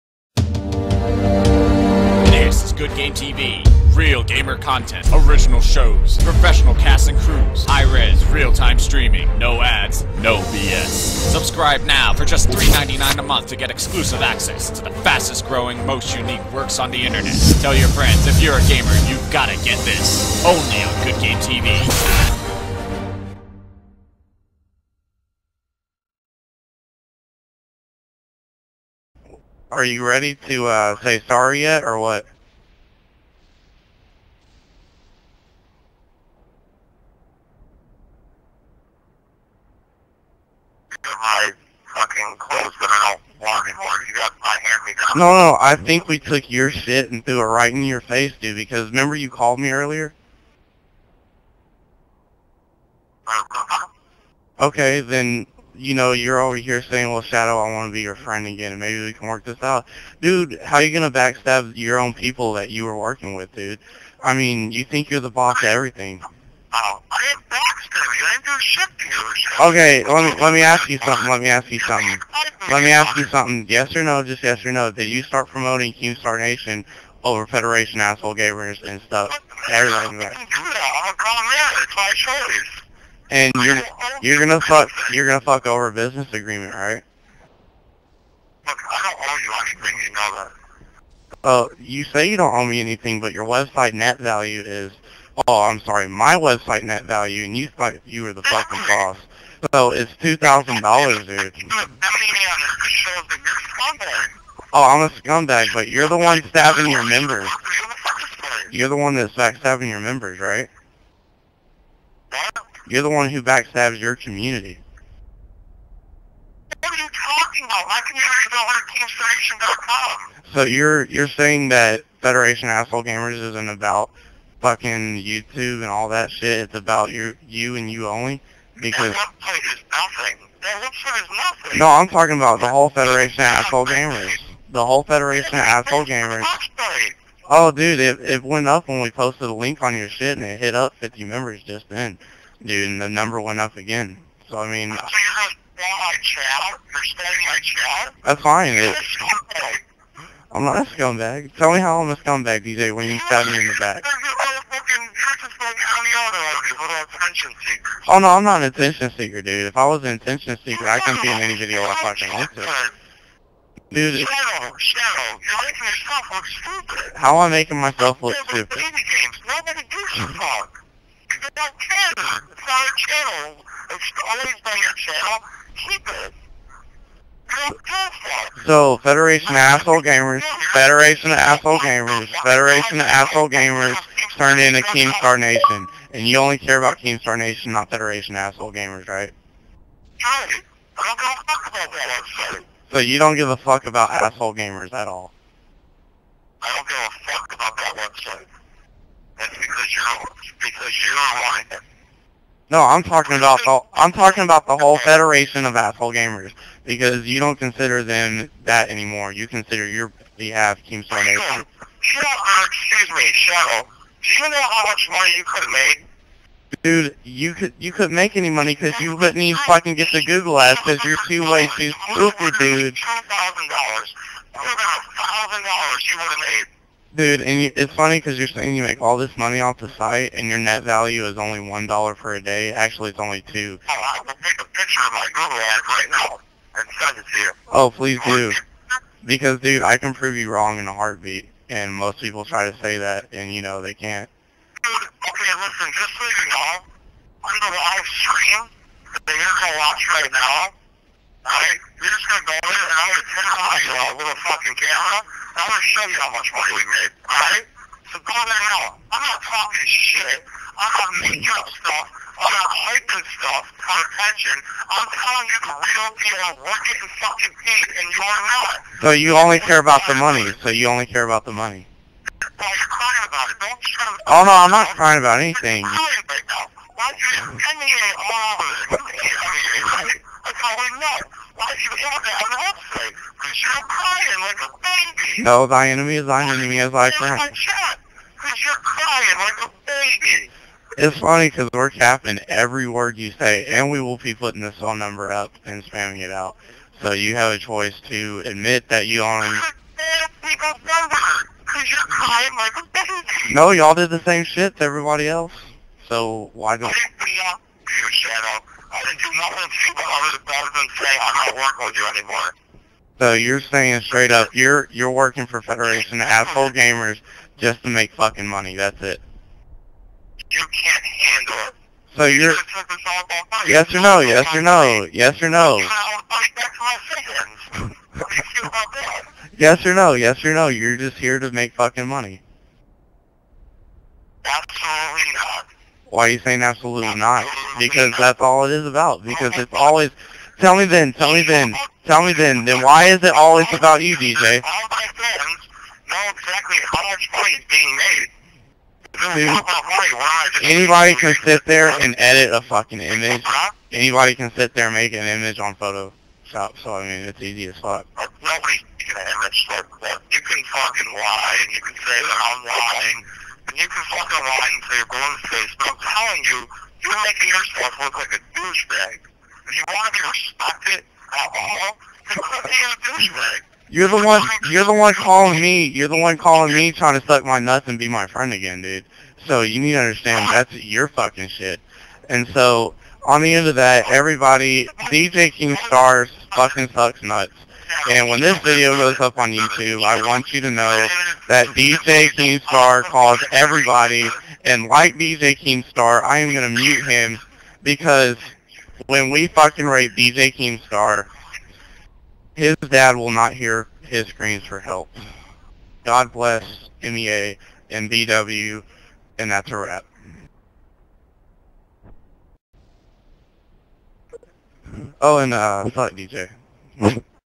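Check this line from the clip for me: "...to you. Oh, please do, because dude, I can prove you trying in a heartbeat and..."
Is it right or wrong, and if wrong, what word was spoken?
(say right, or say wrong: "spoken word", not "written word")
wrong: "wrong", not "trying".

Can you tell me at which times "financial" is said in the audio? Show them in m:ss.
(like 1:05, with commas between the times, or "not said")
not said.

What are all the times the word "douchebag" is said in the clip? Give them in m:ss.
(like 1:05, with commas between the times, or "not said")
6:08, 6:13.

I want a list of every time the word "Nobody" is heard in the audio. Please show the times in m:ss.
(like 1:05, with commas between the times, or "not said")
2:49, 5:58.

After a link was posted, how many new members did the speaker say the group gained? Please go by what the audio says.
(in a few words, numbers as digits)
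50.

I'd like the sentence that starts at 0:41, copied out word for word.
fucking clothes that I don't want anymore.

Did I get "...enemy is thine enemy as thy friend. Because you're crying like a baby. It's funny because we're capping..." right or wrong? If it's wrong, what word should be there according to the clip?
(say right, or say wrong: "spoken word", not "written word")
right.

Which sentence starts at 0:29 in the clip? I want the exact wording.
Are you ready to uh, say sorry yet, or what?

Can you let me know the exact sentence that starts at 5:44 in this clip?
All my friends know exactly how much money is being made.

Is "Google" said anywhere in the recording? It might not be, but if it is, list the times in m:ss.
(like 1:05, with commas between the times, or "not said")
3:40, 3:55.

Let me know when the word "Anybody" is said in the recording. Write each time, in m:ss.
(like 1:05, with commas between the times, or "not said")
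5:49, 5:53.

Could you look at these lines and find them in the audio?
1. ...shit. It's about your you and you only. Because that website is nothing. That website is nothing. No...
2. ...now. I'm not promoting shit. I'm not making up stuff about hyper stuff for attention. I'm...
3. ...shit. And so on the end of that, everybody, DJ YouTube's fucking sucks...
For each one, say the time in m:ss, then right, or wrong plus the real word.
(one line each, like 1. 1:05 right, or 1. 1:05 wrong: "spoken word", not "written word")
1. 2:06 right
2. 4:18 wrong: "talking", not "promoting"
3. 6:21 wrong: "Keemstar", not "YouTube".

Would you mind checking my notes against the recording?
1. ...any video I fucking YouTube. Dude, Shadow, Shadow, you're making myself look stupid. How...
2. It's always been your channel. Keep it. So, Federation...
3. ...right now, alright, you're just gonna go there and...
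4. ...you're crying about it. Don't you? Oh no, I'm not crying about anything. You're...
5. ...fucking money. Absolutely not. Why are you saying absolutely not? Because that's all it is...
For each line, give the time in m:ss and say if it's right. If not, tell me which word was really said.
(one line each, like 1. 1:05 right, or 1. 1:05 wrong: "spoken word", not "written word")
1. 2:41 wrong: "yourself", not "myself"
2. 2:53 right
3. 4:10 right
4. 4:32 right
5. 5:31 right.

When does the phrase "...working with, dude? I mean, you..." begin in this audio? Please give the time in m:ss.
1:02.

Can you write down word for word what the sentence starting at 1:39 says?
So it's two thousand dollars, dude.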